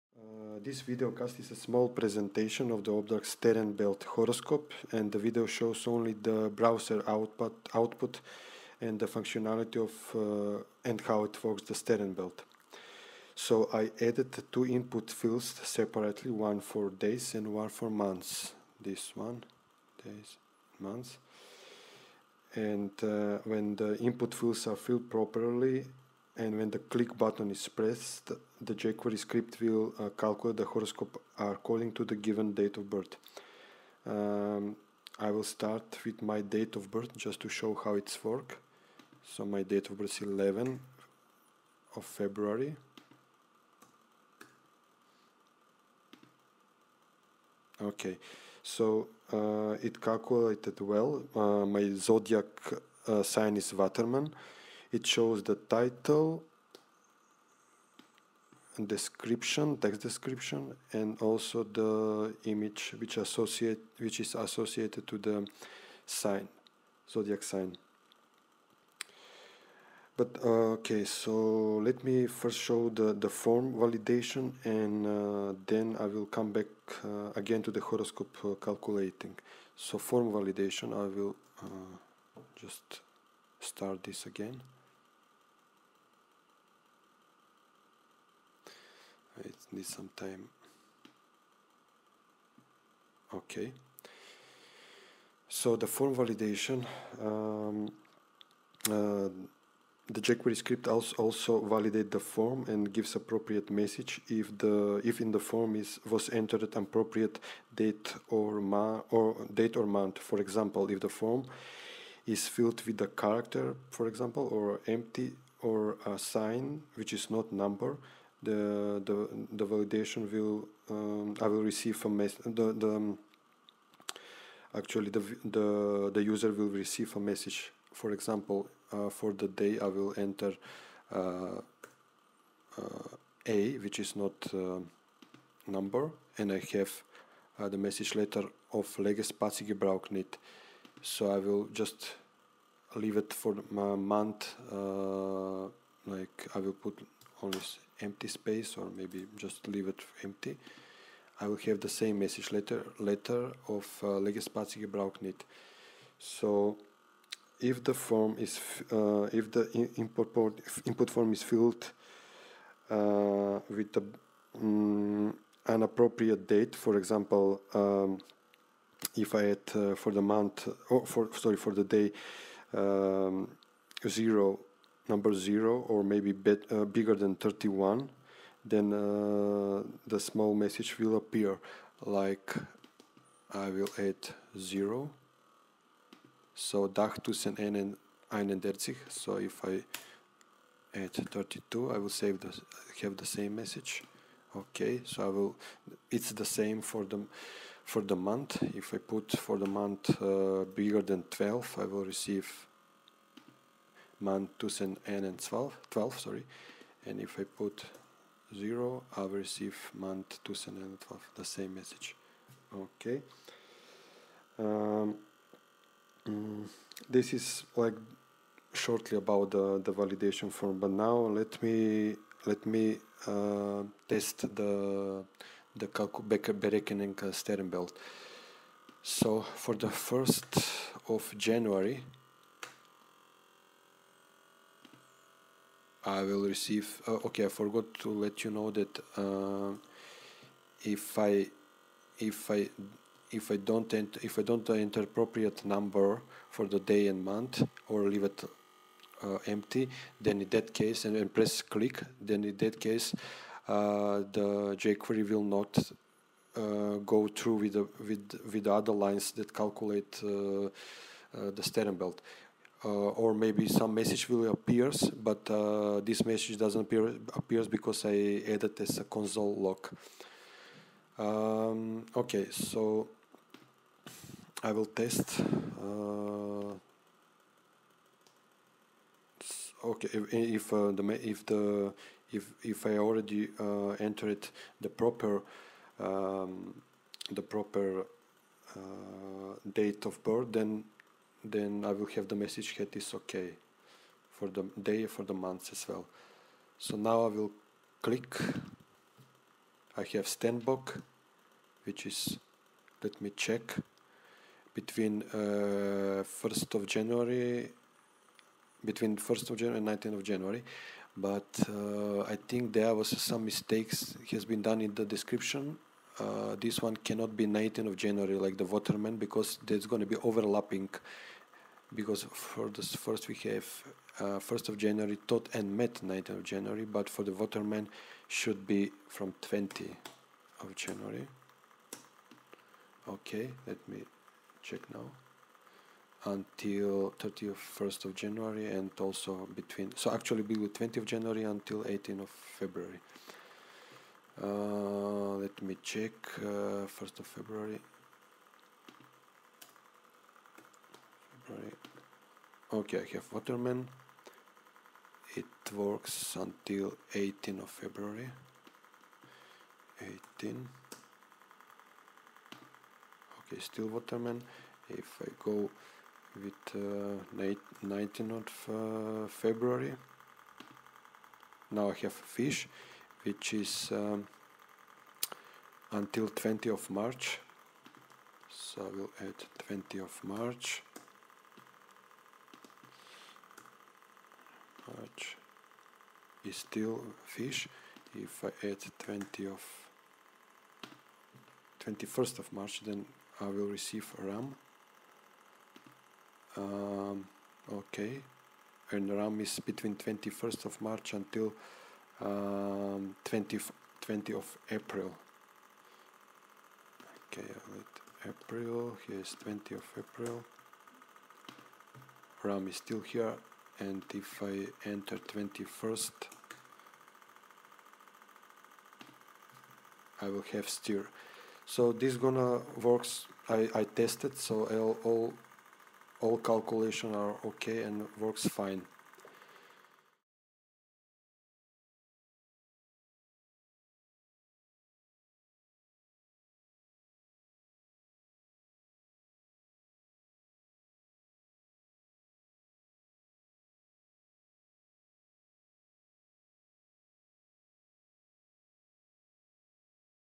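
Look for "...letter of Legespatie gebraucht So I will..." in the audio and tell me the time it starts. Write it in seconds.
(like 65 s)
138 s.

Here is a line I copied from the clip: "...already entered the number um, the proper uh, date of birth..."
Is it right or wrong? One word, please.
wrong.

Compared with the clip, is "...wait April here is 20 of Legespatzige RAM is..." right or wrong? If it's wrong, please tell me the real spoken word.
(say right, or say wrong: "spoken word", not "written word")
wrong: "April", not "Legespatzige".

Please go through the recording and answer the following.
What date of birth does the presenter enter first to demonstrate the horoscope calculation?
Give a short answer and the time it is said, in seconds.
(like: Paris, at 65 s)
11 February, at 40 s.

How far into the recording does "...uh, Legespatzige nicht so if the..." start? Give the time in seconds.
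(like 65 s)
154 s.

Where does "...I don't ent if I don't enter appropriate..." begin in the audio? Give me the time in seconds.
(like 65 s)
243 s.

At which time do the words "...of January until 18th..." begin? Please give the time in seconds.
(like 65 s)
340 s.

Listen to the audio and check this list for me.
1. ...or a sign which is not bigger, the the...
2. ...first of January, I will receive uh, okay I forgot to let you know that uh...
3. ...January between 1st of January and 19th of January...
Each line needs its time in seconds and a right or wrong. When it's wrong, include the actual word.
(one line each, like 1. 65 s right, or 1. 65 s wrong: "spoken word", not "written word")
1. 115 s wrong: "number", not "bigger"
2. 229 s right
3. 306 s right.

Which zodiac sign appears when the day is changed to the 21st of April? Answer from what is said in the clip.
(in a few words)
stir.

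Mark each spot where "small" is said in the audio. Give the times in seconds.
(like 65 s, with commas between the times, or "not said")
1 s, 180 s.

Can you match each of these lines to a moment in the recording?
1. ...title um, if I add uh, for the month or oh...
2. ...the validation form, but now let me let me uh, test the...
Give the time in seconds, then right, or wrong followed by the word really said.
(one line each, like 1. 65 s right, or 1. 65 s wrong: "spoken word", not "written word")
1. 166 s wrong: "example", not "title"
2. 219 s right.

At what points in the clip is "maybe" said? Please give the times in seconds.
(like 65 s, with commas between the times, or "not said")
148 s, 176 s, 263 s.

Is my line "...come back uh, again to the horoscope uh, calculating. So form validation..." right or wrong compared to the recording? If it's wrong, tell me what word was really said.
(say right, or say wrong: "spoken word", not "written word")
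right.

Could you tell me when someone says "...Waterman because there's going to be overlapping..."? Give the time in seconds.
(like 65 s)
318 s.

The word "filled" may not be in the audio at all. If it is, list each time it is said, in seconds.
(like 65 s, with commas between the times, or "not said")
24 s, 112 s, 161 s.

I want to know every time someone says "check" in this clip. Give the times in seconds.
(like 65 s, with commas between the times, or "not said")
303 s, 334 s, 345 s.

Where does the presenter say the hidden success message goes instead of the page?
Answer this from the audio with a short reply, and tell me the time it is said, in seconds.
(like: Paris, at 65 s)
console log, at 269 s.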